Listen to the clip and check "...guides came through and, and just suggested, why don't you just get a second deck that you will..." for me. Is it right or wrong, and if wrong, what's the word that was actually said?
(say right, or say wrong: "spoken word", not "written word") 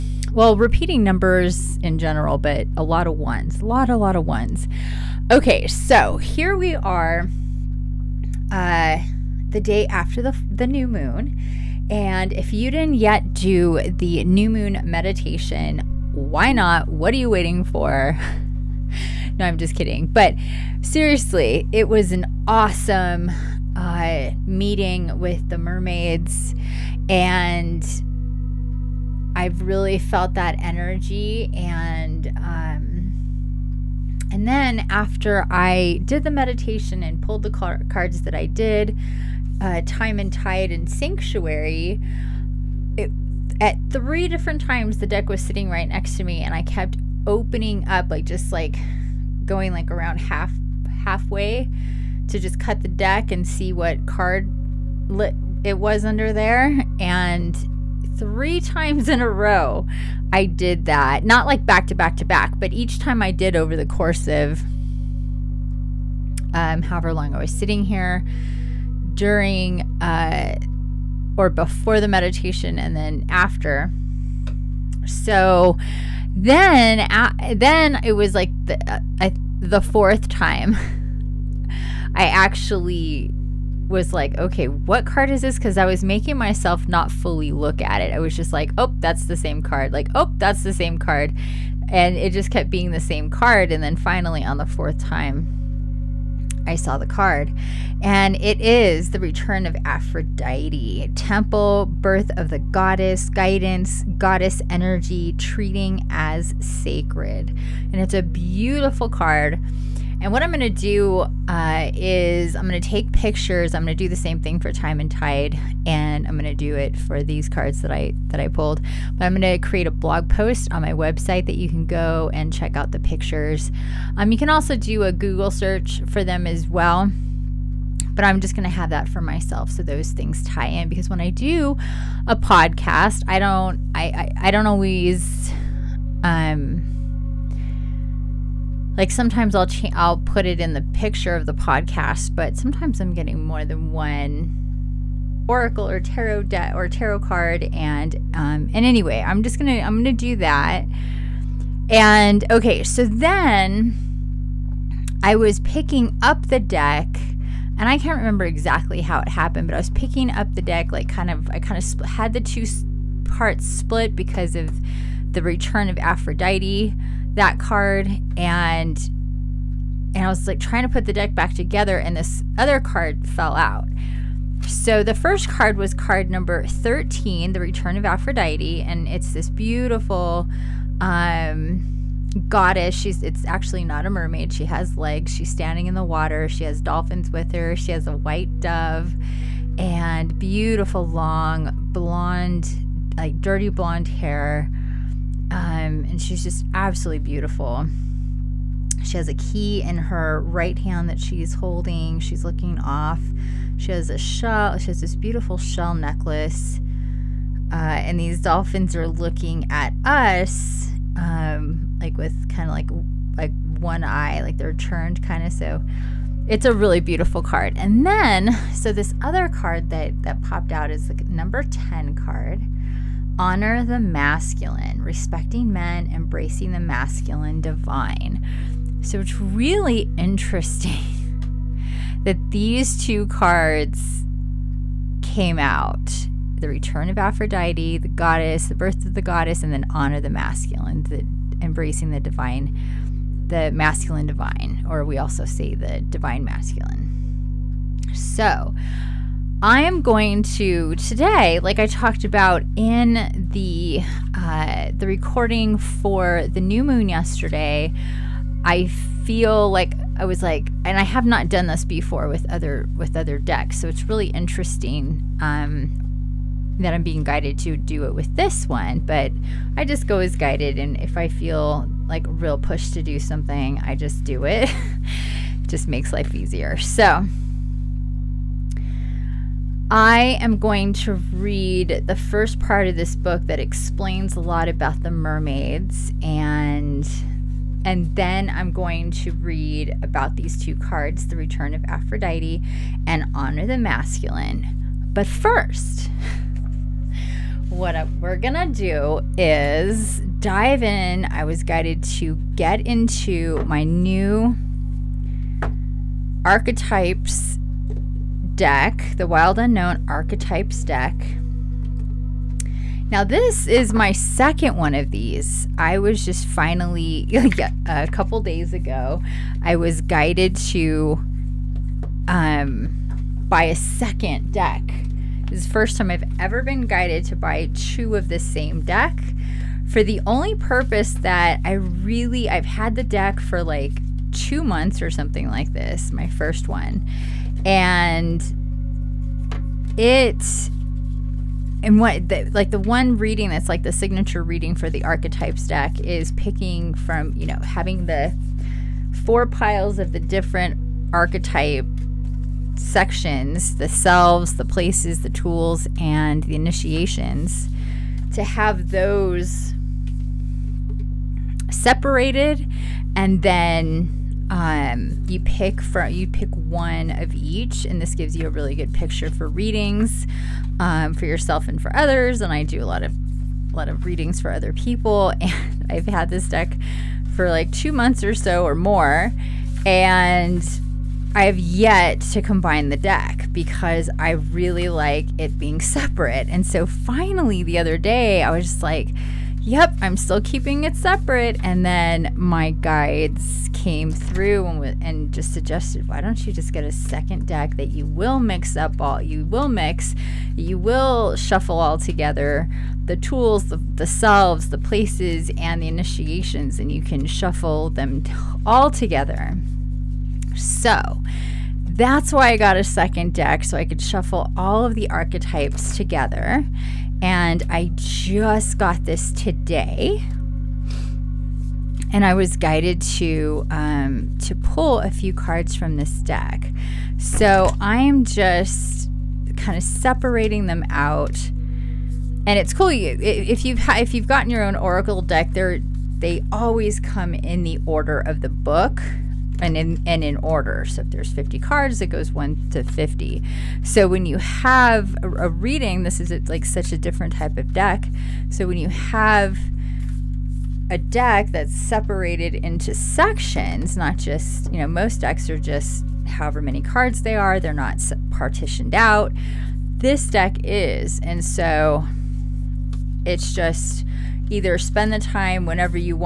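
right.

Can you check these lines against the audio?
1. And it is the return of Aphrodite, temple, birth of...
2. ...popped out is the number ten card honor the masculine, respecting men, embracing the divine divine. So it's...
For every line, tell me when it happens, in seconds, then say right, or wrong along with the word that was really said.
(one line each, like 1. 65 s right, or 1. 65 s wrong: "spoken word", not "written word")
1. 98 s right
2. 220 s wrong: "masculine", not "divine".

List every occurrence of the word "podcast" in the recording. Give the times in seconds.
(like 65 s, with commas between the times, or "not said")
132 s, 141 s.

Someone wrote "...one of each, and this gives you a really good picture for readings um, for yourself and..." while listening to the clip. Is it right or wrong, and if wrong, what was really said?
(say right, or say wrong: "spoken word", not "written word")
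right.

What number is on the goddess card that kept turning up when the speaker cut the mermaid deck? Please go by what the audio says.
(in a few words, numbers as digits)
13.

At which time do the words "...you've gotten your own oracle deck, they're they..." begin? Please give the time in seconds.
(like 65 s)
434 s.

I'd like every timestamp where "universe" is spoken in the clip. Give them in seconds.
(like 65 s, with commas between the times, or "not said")
not said.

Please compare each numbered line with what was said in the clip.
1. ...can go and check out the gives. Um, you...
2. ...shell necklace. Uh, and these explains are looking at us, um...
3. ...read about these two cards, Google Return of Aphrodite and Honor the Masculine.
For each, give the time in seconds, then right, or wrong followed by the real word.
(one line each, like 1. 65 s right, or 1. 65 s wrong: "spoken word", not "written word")
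1. 121 s wrong: "pictures", not "gives"
2. 205 s wrong: "dolphins", not "explains"
3. 289 s wrong: "The", not "Google".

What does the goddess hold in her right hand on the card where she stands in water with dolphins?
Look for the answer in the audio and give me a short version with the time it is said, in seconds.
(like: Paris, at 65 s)
a key, at 199 s.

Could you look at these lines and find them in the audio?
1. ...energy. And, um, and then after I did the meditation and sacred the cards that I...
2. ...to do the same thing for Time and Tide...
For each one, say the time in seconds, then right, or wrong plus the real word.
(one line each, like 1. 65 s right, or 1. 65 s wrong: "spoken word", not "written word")
1. 30 s wrong: "pulled", not "sacred"
2. 113 s right.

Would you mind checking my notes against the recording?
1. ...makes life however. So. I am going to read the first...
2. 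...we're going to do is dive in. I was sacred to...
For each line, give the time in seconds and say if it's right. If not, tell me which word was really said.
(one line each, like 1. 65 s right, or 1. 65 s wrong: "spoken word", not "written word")
1. 275 s wrong: "easier", not "however"
2. 298 s wrong: "guided", not "sacred".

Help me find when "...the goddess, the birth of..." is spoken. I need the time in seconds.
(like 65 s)
237 s.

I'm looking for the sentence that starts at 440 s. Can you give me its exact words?
So if there's 50 cards, it goes 1 to 50.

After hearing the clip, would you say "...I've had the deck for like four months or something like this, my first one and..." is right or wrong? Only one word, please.
wrong.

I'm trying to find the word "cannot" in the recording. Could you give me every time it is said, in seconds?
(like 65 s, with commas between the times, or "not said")
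not said.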